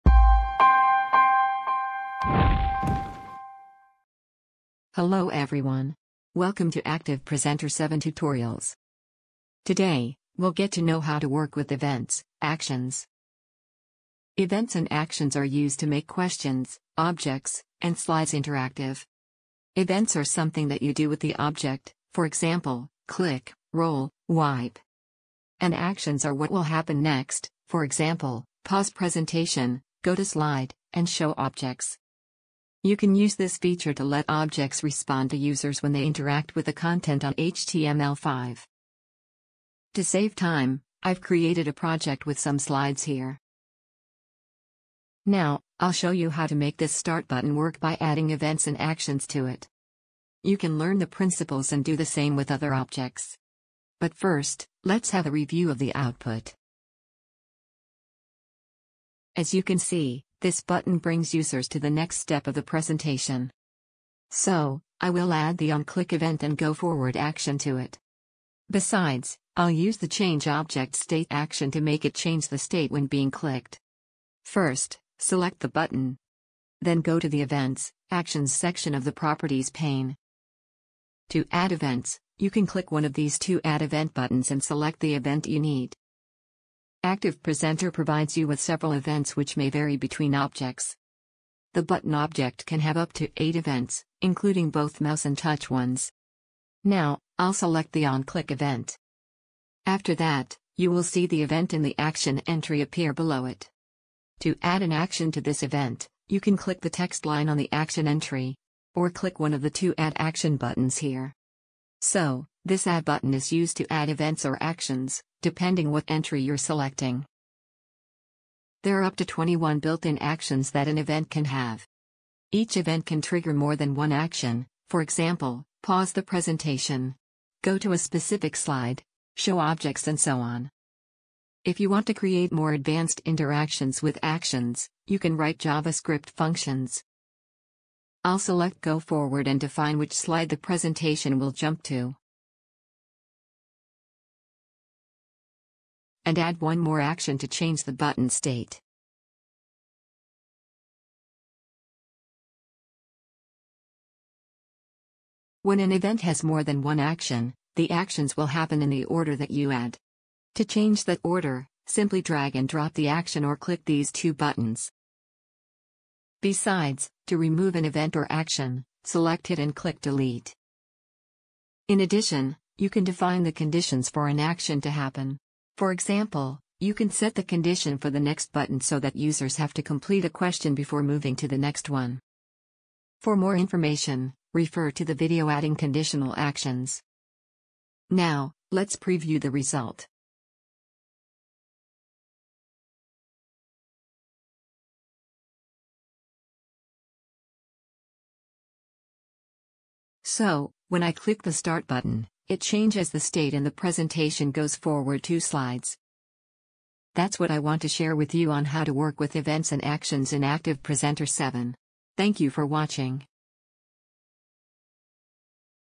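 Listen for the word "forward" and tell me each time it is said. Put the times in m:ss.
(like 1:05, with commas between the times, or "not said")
1:06, 2:18, 3:24.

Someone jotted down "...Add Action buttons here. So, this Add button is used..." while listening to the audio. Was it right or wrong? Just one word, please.
right.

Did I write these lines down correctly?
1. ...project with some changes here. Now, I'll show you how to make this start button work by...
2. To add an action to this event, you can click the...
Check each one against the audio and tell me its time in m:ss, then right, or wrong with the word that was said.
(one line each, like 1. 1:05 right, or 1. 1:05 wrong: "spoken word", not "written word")
1. 0:41 wrong: "slides", not "changes"
2. 1:44 right.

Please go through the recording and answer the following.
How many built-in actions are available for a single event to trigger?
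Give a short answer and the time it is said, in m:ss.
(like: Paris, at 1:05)
21, at 1:59.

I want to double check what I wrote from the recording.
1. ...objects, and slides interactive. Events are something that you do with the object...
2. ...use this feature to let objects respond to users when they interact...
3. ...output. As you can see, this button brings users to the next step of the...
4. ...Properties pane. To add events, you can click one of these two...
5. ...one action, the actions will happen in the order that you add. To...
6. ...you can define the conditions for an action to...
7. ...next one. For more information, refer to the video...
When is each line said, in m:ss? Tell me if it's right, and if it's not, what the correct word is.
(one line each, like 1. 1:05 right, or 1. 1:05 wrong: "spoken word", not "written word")
1. 0:16 right
2. 0:33 right
3. 0:55 right
4. 1:19 right
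5. 2:36 right
6. 2:52 right
7. 3:01 right.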